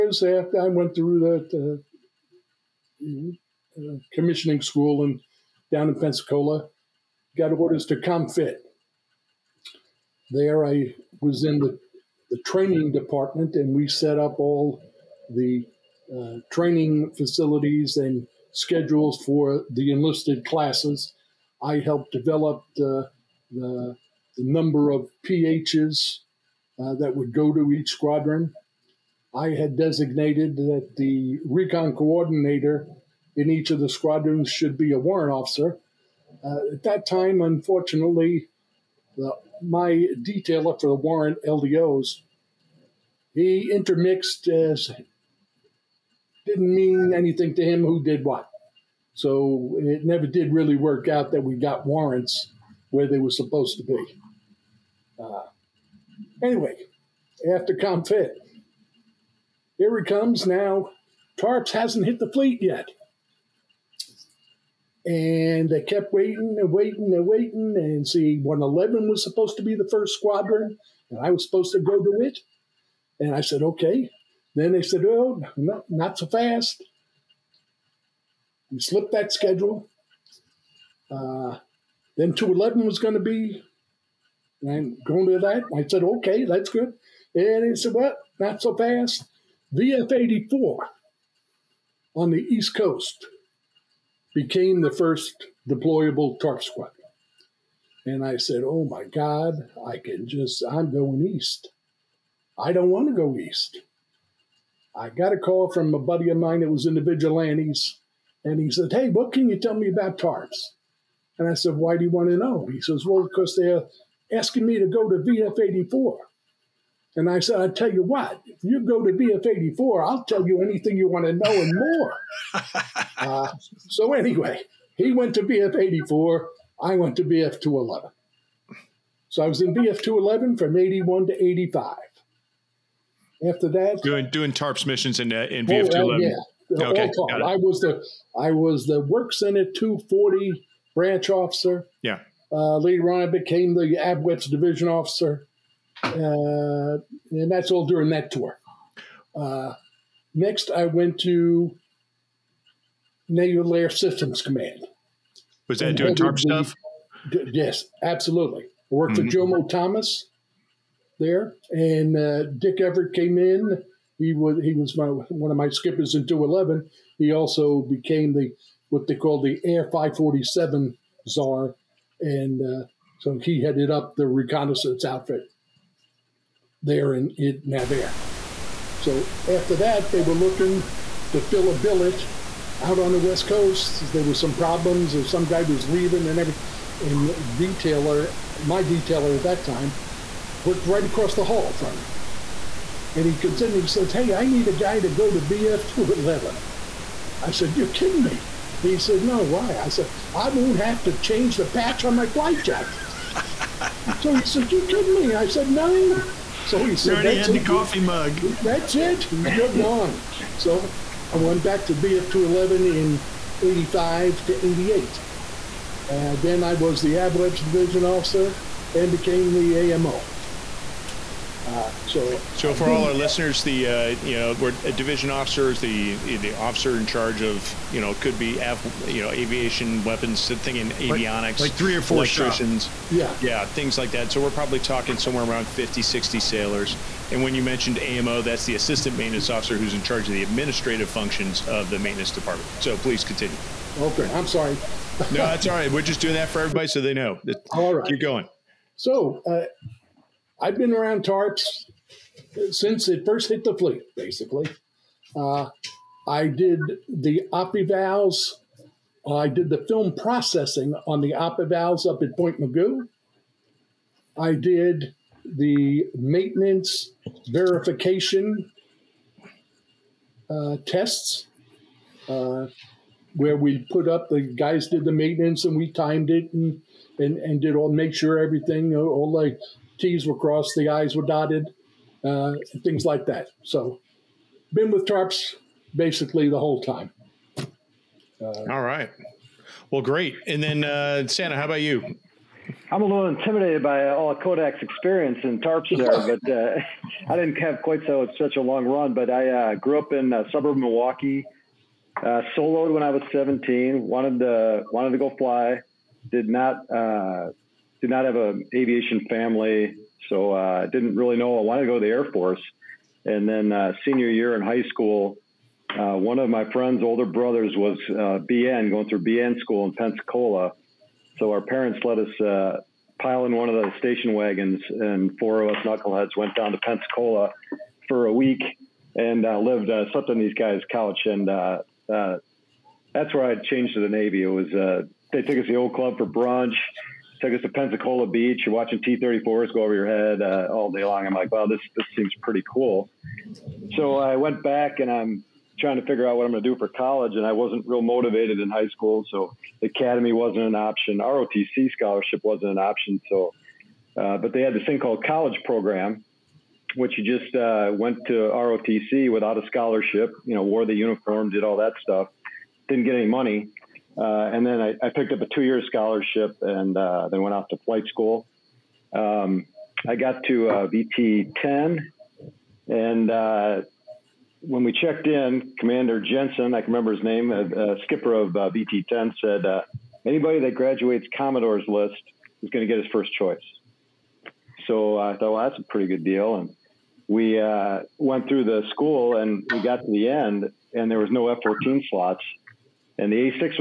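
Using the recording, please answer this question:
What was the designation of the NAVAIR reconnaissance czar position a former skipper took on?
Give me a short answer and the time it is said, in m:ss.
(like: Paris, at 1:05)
Air 547, at 2:49.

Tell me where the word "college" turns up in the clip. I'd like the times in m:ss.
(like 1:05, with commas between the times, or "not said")
5:46, 5:55.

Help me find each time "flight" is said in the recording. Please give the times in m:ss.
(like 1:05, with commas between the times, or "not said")
3:22, 6:07.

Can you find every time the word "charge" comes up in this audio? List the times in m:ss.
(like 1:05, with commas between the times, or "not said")
3:47, 4:00.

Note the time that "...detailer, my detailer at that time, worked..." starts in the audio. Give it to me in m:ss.
3:07.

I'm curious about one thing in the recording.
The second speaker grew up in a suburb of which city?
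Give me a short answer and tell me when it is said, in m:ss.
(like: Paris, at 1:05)
Milwaukee, at 5:00.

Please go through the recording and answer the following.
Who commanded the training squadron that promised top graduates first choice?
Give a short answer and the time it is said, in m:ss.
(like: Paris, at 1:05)
Commander Jensen, at 6:15.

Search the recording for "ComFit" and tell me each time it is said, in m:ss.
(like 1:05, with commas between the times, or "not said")
0:07, 0:57.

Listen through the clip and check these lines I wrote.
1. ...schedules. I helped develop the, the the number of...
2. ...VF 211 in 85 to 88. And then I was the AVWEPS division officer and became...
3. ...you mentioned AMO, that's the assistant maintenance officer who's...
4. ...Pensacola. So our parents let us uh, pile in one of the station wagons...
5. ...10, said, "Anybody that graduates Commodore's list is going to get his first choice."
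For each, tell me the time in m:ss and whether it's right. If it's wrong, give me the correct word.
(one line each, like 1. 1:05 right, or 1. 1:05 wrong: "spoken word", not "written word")
1. 0:20 wrong: "classes", not "schedules"
2. 3:31 right
3. 3:57 right
4. 5:19 right
5. 6:19 right.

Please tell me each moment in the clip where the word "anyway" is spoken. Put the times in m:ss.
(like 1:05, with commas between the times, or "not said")
0:56, 2:04.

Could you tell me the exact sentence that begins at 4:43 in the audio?
So, been with tarps basically the whole time.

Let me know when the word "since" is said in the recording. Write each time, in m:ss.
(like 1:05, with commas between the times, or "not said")
4:12.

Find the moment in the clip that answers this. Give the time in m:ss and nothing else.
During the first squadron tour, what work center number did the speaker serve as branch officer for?
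2:19.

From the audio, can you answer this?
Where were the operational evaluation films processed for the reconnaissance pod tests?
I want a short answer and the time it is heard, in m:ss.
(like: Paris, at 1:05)
Point Mugu, at 4:22.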